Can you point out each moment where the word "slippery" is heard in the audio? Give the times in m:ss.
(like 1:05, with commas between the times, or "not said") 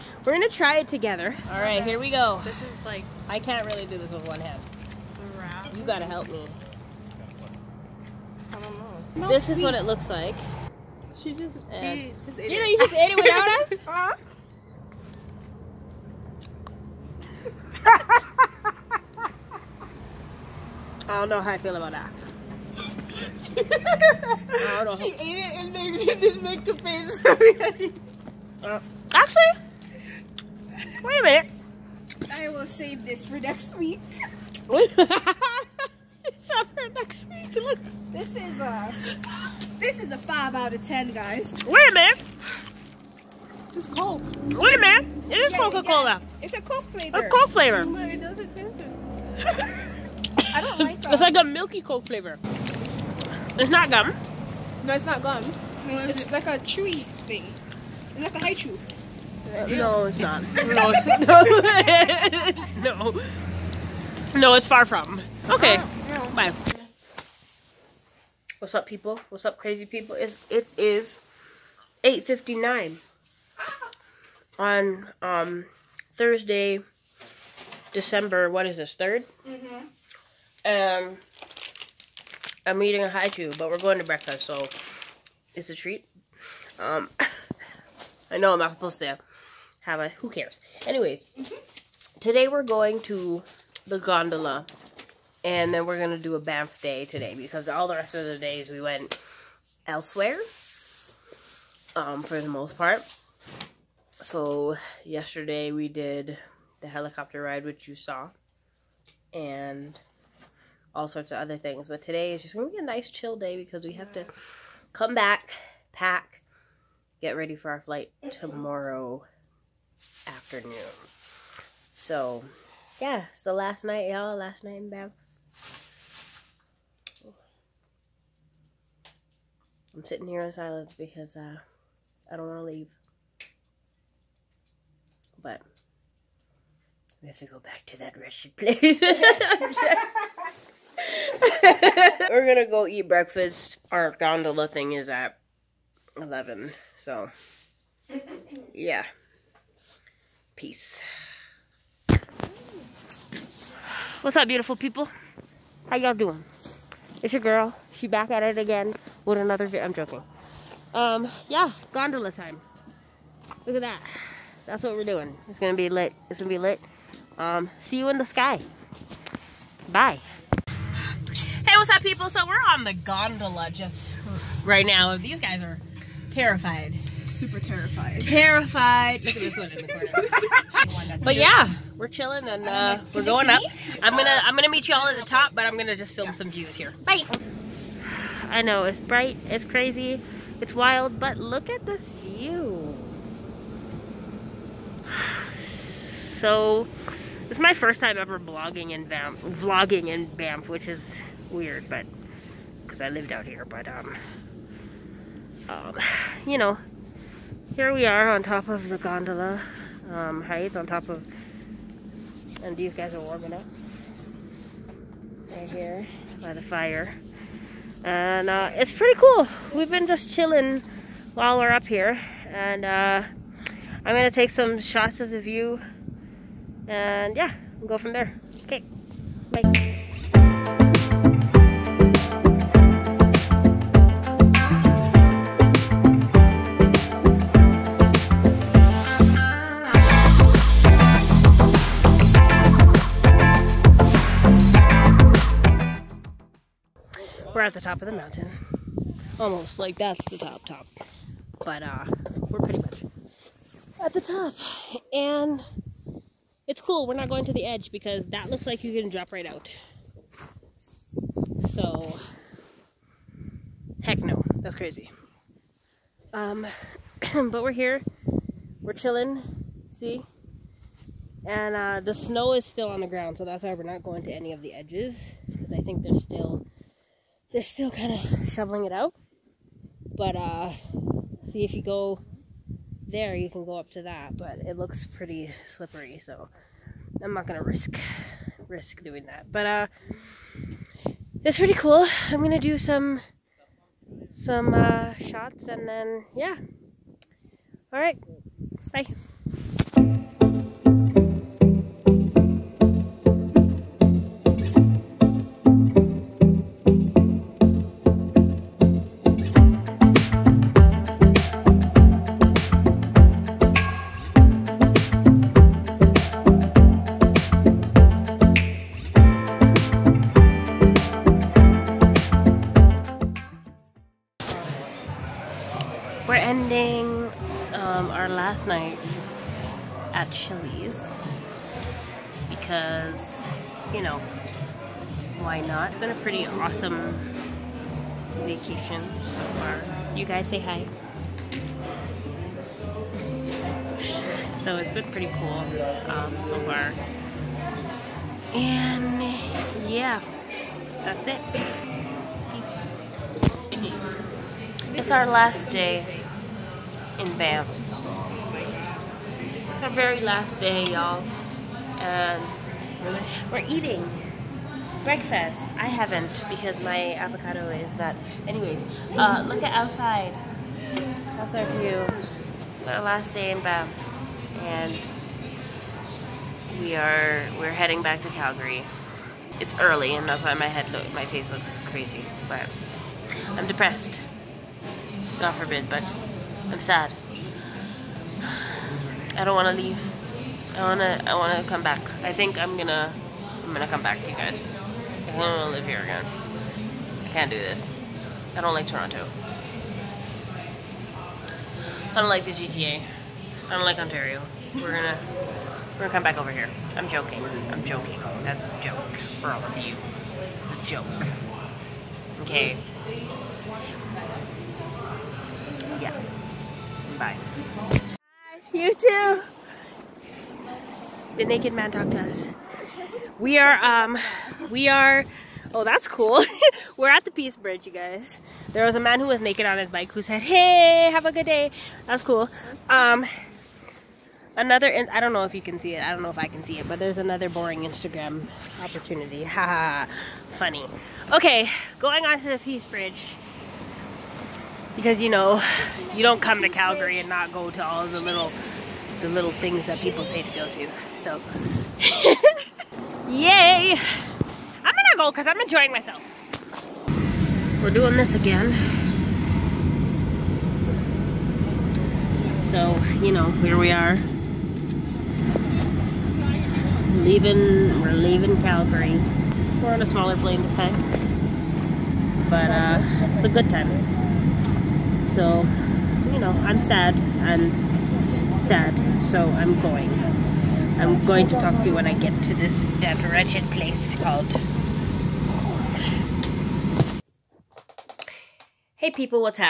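4:45.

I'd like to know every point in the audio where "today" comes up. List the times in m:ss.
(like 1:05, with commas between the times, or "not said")
1:32, 1:37, 1:52.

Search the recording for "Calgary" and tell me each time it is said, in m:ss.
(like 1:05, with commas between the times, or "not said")
6:18, 7:26, 7:48.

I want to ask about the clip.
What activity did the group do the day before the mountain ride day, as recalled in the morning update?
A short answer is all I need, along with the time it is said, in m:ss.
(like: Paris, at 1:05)
helicopter ride, at 1:46.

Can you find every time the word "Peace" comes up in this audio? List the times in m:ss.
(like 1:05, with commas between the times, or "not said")
2:30, 7:07, 7:22.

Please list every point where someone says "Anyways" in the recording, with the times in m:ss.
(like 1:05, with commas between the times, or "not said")
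1:30, 6:08.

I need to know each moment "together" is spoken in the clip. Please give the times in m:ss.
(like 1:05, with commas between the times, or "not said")
0:00.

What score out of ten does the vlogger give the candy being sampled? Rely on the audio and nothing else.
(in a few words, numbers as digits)
5.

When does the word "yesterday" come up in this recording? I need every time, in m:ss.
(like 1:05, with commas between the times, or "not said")
1:45.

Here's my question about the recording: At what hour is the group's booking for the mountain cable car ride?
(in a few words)
11.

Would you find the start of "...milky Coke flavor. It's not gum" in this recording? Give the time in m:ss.
0:51.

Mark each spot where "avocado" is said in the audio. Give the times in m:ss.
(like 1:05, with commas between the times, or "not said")
6:07.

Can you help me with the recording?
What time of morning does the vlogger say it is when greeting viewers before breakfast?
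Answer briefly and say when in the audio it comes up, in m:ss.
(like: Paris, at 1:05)
8.59, at 1:12.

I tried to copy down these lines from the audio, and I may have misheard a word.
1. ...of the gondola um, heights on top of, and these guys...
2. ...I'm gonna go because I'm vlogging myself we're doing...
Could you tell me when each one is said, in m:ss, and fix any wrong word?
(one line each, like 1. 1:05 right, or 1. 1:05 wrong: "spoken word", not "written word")
1. 3:28 right
2. 7:34 wrong: "enjoying", not "vlogging".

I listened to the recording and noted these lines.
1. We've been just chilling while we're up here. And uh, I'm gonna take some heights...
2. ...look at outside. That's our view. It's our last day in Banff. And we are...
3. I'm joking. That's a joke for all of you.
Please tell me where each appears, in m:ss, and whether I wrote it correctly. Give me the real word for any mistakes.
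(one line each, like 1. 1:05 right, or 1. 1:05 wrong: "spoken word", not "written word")
1. 3:39 wrong: "shots", not "heights"
2. 6:09 right
3. 6:47 right.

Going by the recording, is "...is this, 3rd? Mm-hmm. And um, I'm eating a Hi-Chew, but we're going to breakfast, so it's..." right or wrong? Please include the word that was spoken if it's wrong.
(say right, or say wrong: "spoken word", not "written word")
right.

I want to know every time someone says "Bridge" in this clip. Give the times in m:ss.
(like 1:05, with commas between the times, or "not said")
7:07, 7:22.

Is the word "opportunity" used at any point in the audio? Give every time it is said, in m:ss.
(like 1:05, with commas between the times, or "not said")
7:18.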